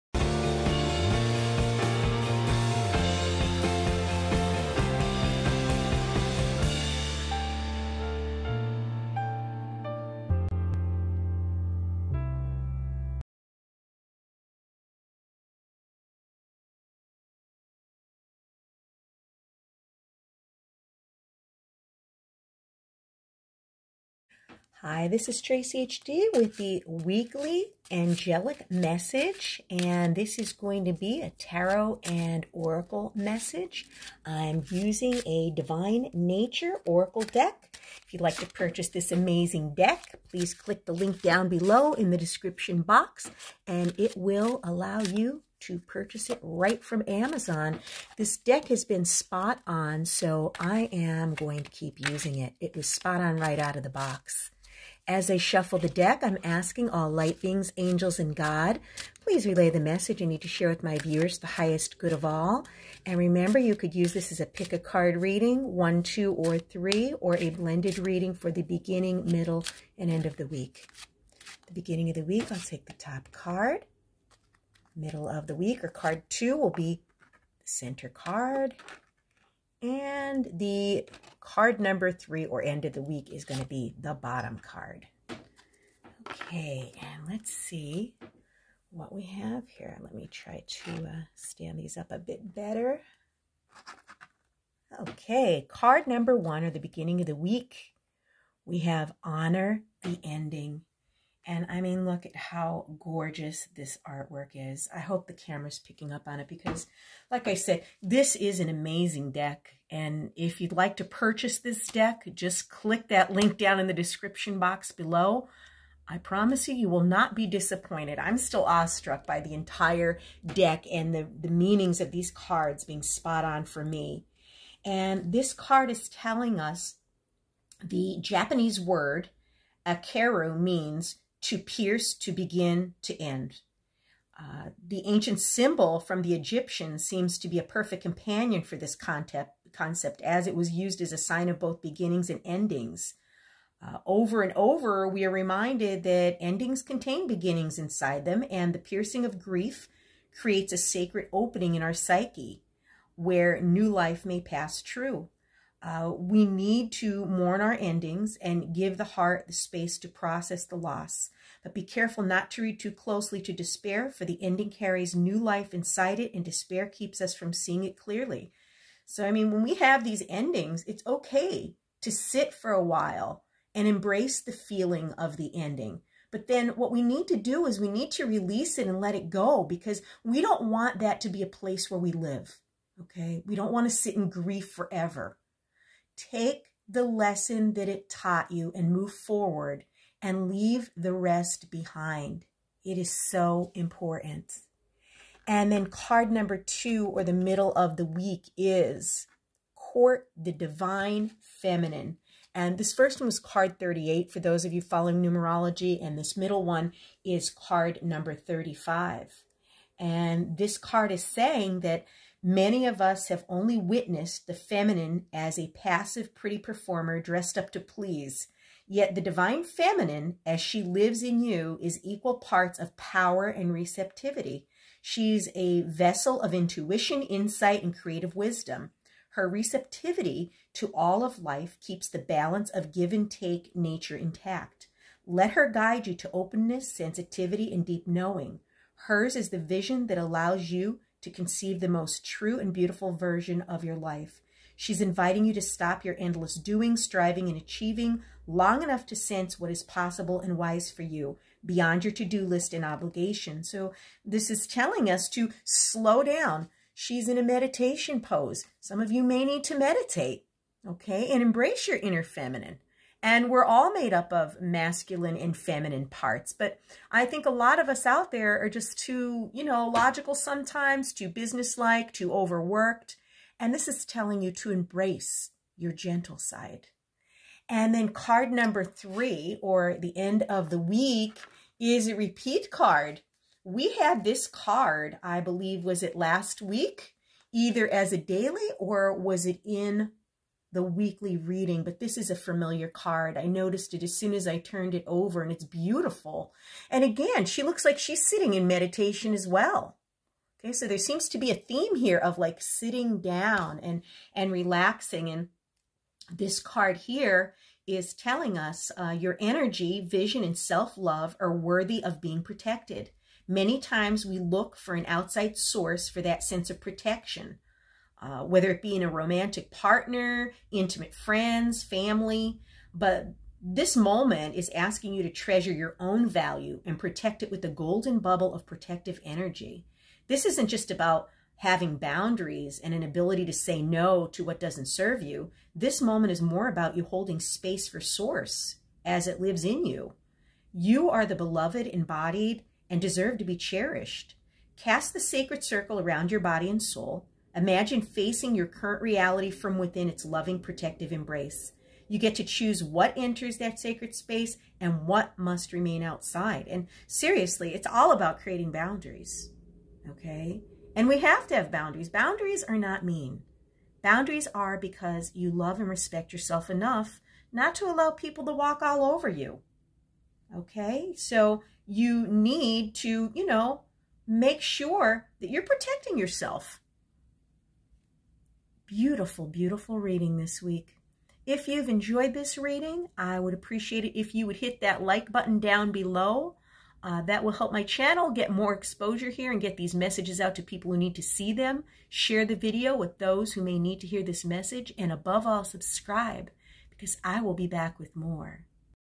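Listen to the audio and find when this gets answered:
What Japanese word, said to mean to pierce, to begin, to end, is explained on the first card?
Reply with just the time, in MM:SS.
02:09.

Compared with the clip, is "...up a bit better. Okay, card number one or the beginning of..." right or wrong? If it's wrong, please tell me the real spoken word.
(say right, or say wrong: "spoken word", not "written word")
right.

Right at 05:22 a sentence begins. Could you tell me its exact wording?
But this moment is asking you to treasure your own value and protect it with the golden bubble of protective energy.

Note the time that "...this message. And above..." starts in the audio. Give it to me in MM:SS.
06:34.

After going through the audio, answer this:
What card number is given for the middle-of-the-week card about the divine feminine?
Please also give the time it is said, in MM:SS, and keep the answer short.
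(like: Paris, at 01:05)
35, at 03:27.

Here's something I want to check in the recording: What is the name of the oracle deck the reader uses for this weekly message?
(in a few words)
Divine Nature oracle deck.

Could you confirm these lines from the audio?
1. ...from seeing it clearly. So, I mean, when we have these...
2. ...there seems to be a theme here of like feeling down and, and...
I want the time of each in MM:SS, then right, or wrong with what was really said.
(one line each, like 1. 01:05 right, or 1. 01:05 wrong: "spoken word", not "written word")
1. 02:47 right
2. 05:00 wrong: "sitting", not "feeling".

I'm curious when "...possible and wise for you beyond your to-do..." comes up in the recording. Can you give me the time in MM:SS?
04:09.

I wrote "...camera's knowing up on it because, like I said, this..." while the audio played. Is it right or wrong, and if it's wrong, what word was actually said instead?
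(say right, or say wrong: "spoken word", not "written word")
wrong: "picking", not "knowing".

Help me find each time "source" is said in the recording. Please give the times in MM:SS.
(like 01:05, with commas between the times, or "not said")
05:15, 05:37.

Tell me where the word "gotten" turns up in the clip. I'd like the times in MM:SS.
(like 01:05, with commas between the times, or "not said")
not said.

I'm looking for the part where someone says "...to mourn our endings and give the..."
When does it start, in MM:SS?
02:36.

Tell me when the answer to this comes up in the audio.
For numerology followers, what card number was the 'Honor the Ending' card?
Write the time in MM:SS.
03:23.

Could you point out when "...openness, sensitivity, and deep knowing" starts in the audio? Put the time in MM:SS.
03:56.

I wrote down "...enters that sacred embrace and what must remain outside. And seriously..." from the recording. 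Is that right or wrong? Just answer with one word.
wrong.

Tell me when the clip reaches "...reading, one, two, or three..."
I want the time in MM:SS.
01:05.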